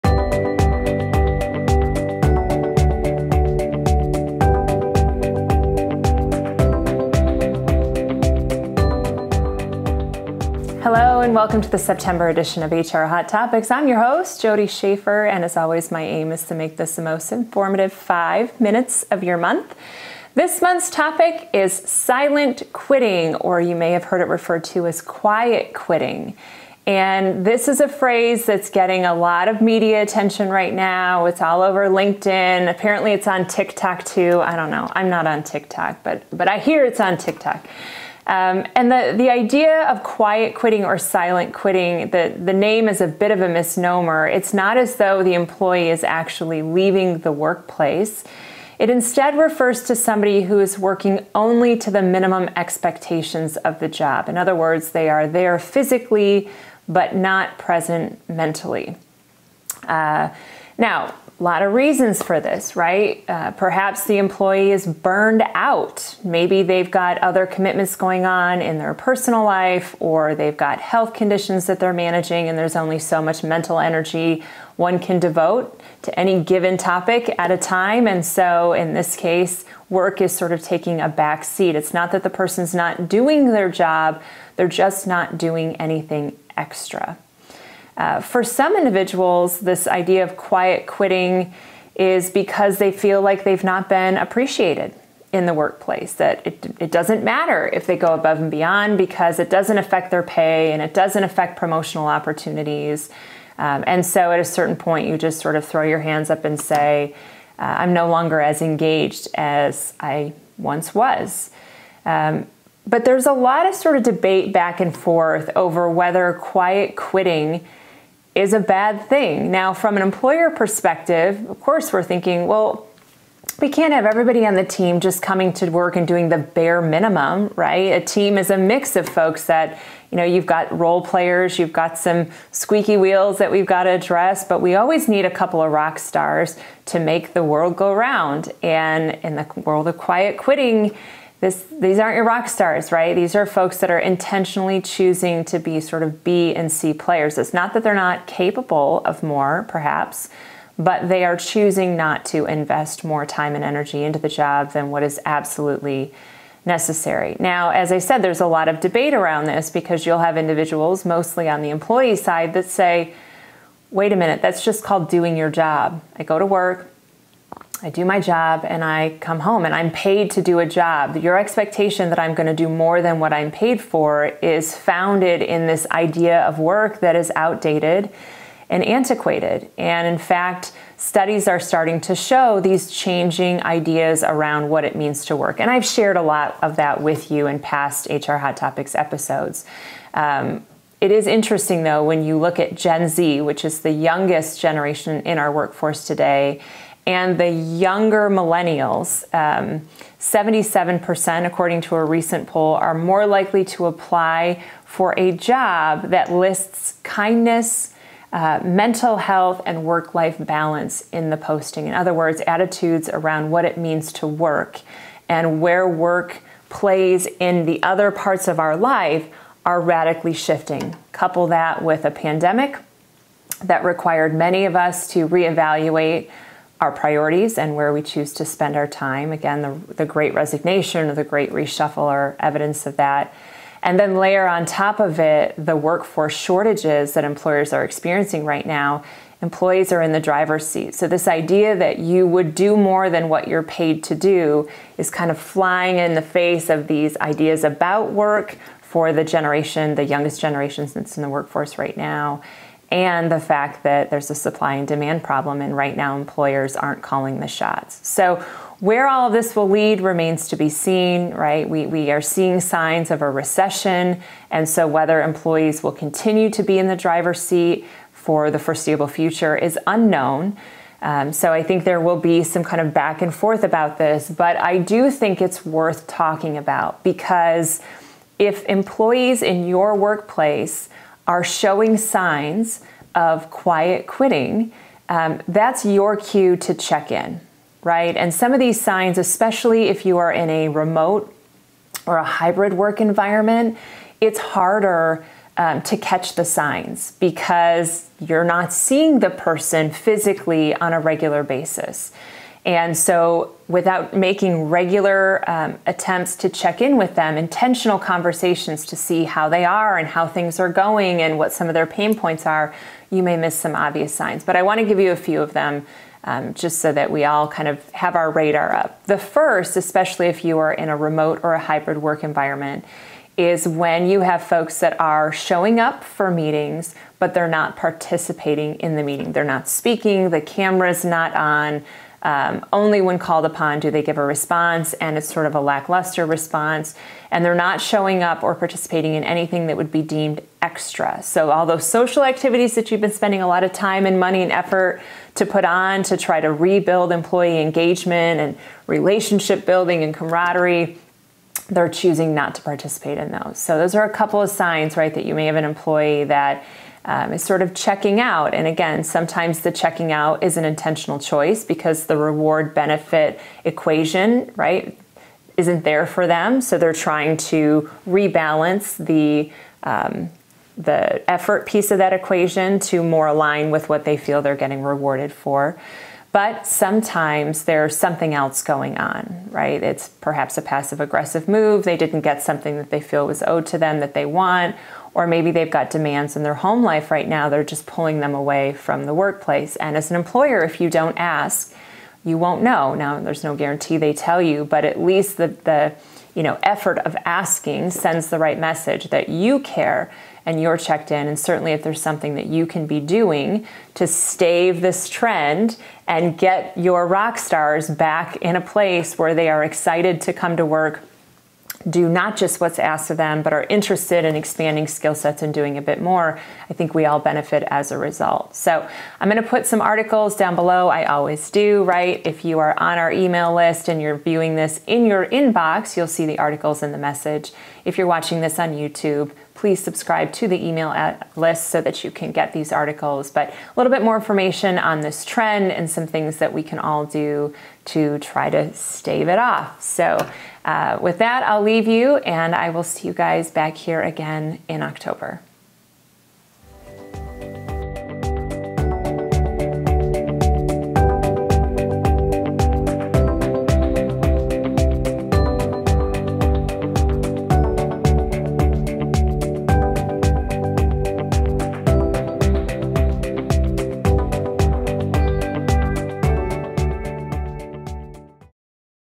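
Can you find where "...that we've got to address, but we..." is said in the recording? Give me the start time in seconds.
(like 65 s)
133 s.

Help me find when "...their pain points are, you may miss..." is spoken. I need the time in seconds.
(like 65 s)
311 s.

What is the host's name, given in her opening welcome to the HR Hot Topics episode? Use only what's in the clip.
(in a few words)
Jodi Schafer.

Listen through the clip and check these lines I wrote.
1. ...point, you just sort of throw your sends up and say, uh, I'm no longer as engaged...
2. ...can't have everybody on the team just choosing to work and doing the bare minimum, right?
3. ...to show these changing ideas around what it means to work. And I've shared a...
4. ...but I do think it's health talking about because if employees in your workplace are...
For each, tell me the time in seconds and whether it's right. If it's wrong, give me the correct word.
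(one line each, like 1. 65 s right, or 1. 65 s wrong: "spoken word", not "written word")
1. 104 s wrong: "hands", not "sends"
2. 123 s wrong: "coming", not "choosing"
3. 182 s right
4. 274 s wrong: "worth", not "health".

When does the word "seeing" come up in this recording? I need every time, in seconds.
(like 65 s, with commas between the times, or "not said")
262 s, 298 s.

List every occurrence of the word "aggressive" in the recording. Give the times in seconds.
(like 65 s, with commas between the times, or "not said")
381 s.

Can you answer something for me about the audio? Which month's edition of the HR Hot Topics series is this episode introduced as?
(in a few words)
September.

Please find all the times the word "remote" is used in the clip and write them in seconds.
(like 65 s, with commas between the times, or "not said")
290 s, 320 s.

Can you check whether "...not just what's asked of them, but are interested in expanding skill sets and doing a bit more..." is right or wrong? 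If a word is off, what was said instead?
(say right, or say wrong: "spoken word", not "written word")
right.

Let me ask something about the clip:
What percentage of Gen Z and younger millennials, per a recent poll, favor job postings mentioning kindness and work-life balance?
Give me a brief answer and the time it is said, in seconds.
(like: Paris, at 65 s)
77%, at 200 s.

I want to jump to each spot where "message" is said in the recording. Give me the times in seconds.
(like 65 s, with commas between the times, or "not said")
398 s, 426 s.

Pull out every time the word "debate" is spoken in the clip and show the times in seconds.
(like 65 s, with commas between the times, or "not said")
114 s, 158 s.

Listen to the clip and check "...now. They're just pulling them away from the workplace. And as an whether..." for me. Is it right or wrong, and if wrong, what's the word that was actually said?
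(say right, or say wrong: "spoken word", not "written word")
wrong: "employer", not "whether".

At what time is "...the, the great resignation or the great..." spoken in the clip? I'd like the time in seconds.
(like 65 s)
229 s.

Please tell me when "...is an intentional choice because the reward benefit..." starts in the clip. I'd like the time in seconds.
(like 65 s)
360 s.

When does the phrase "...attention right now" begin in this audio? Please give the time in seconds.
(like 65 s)
30 s.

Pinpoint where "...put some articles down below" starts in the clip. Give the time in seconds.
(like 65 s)
419 s.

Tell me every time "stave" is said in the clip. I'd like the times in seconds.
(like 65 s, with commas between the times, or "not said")
404 s, 438 s.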